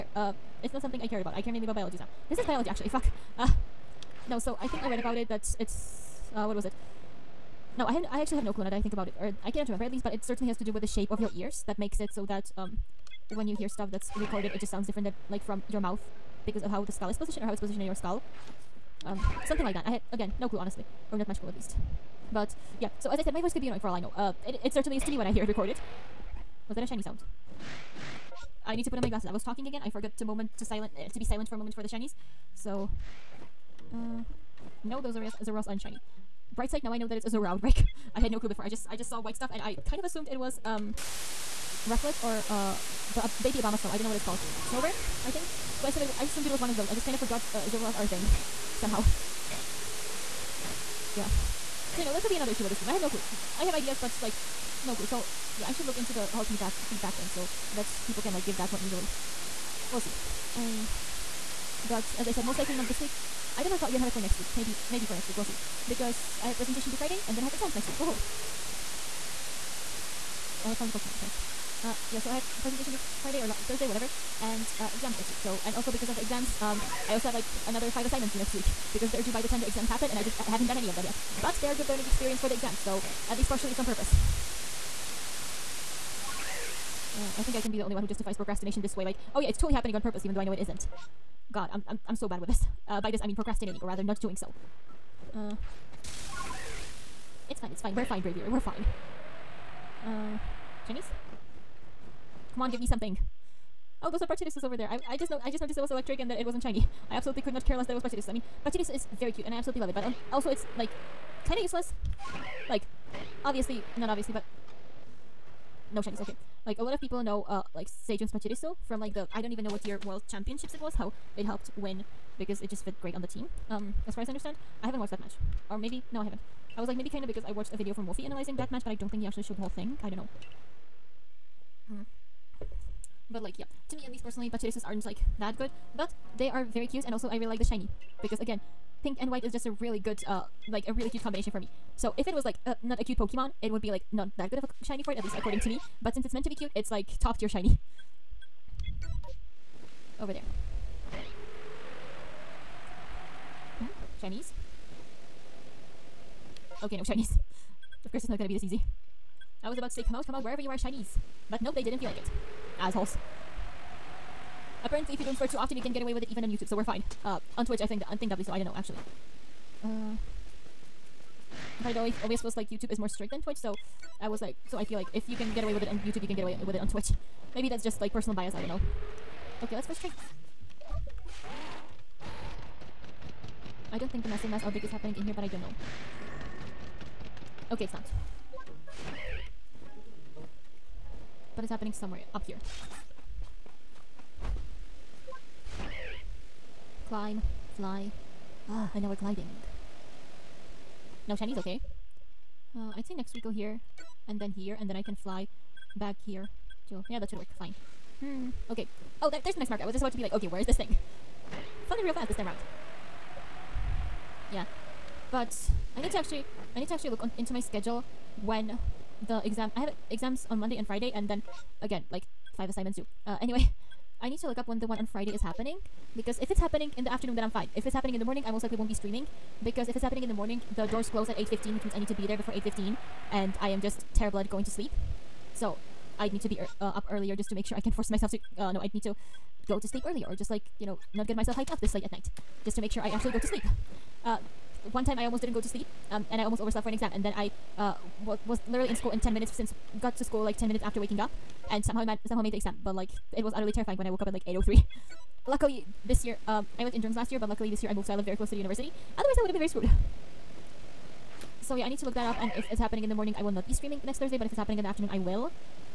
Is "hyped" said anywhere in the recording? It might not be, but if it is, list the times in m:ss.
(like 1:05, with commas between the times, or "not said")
4:01.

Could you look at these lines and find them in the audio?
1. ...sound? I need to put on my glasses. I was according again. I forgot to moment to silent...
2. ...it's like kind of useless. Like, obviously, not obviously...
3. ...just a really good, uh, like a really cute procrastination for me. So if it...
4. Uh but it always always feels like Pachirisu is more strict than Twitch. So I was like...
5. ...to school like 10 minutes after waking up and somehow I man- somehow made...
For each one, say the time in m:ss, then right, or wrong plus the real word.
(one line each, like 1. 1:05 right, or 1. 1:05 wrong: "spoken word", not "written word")
1. 0:27 wrong: "talking", not "according"
2. 1:50 right
3. 2:19 wrong: "combination", not "procrastination"
4. 2:49 wrong: "YouTube", not "Pachirisu"
5. 4:10 right.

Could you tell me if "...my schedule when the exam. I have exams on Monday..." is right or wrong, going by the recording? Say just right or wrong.
right.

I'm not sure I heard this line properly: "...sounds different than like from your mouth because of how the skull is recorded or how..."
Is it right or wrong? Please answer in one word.
wrong.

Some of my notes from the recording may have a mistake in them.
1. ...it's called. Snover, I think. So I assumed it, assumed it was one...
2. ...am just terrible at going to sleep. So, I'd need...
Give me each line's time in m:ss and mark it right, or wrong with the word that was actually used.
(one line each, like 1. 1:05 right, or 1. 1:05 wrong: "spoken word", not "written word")
1. 0:44 right
2. 3:53 right.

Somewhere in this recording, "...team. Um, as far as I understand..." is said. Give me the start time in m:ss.
2:03.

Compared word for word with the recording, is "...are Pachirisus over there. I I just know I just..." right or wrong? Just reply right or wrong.
right.